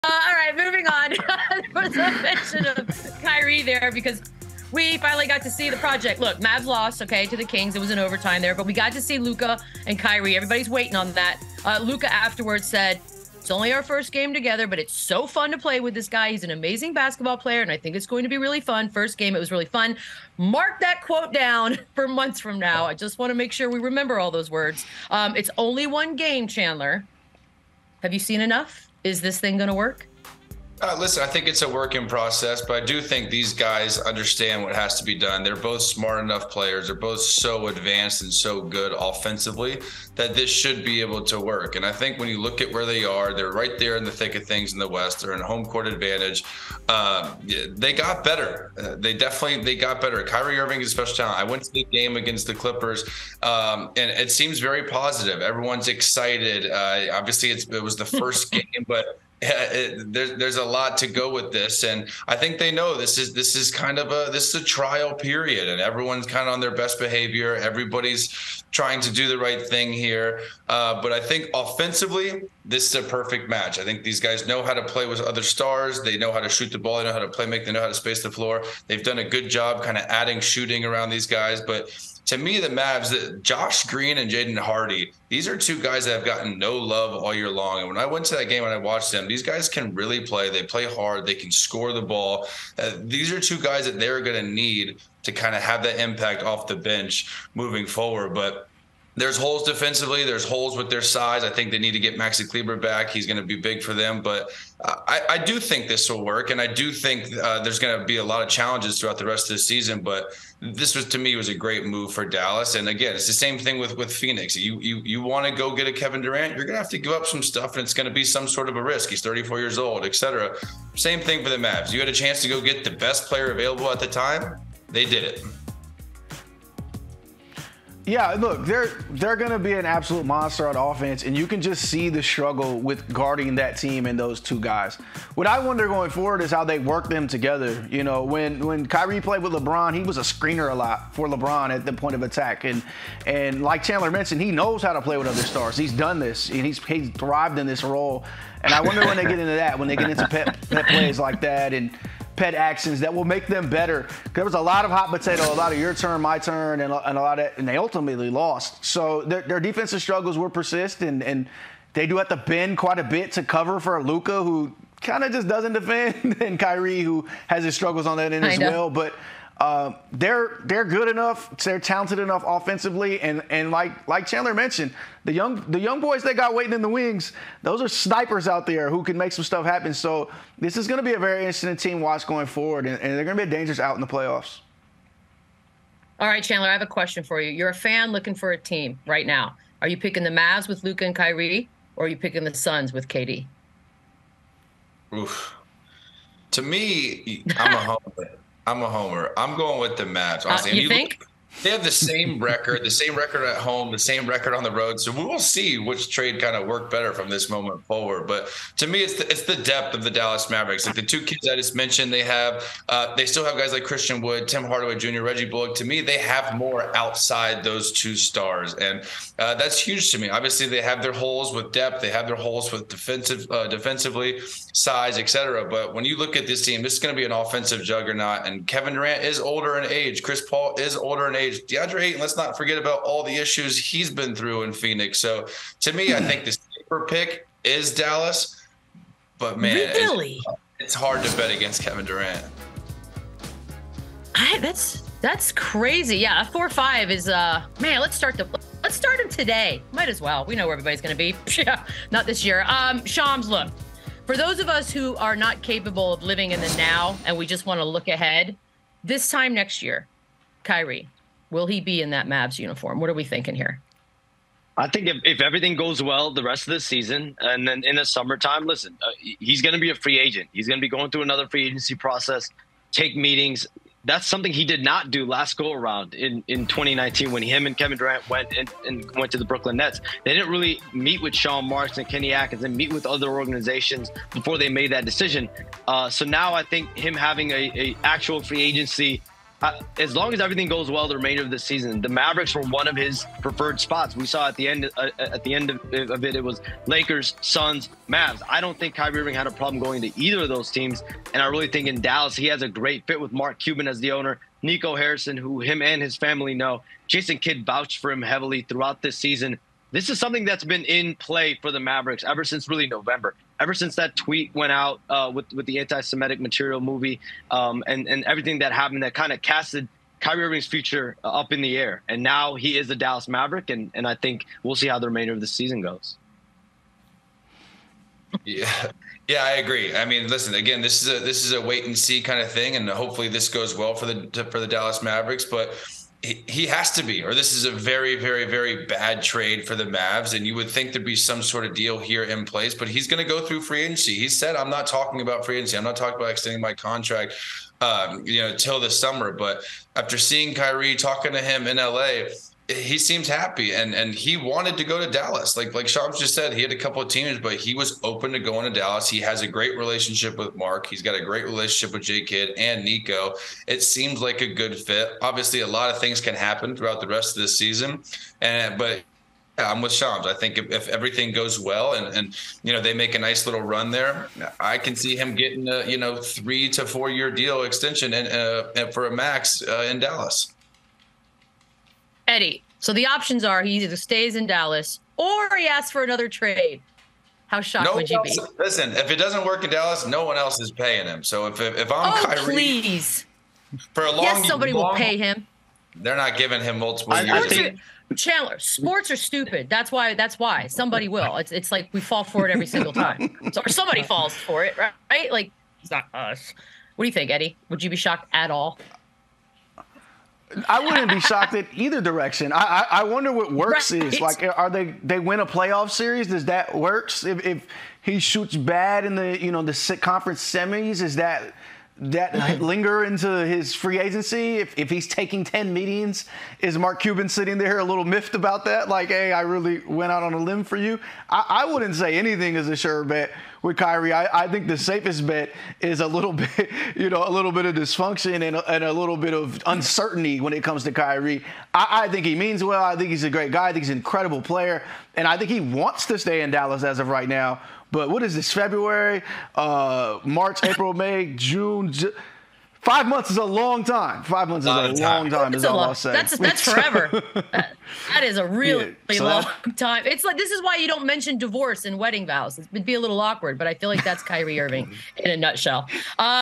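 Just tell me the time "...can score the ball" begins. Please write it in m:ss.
1:31.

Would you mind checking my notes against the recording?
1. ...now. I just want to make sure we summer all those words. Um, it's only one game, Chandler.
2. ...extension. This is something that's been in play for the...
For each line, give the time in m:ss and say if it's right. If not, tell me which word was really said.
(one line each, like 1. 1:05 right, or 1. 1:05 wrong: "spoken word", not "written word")
1. 0:22 wrong: "remember", not "summer"
2. 5:09 wrong: "season", not "extension".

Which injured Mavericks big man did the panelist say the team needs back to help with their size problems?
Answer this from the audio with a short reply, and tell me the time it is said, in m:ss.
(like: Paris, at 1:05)
Maxi Kleber, at 1:42.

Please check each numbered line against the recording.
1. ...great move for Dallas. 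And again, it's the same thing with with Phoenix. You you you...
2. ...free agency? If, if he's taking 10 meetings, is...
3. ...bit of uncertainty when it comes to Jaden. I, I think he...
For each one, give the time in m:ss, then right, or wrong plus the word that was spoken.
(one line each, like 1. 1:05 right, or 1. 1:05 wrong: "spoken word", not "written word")
1. 1:51 right
2. 7:03 right
3. 7:19 wrong: "Kyrie", not "Jaden".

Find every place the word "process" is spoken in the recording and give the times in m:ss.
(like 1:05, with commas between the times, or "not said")
0:32, 4:31.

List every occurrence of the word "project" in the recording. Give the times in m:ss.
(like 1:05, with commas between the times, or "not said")
0:05.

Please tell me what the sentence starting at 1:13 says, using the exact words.
I think these guys know how to play with other stars.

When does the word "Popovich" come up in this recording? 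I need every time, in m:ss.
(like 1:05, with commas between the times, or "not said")
not said.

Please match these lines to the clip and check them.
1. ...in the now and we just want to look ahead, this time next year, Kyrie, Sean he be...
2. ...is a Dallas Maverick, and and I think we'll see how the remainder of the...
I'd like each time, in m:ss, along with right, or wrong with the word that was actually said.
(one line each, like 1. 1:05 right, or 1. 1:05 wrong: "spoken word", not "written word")
1. 4:16 wrong: "Will", not "Sean"
2. 5:22 right.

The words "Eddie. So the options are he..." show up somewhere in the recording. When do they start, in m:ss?
6:22.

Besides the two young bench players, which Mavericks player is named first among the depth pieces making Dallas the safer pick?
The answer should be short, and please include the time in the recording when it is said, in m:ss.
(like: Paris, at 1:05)
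Christian Wood, at 3:33.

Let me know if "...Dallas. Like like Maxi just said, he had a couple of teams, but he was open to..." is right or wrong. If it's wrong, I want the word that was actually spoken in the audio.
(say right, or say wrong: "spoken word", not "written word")
wrong: "Shams", not "Maxi".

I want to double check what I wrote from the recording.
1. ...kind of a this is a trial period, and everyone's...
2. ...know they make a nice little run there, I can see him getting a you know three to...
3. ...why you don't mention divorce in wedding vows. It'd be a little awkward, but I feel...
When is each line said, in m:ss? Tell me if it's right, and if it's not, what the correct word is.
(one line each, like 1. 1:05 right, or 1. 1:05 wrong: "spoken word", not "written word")
1. 1:03 right
2. 6:12 right
3. 7:40 right.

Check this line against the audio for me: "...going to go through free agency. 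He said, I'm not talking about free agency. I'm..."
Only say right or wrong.
right.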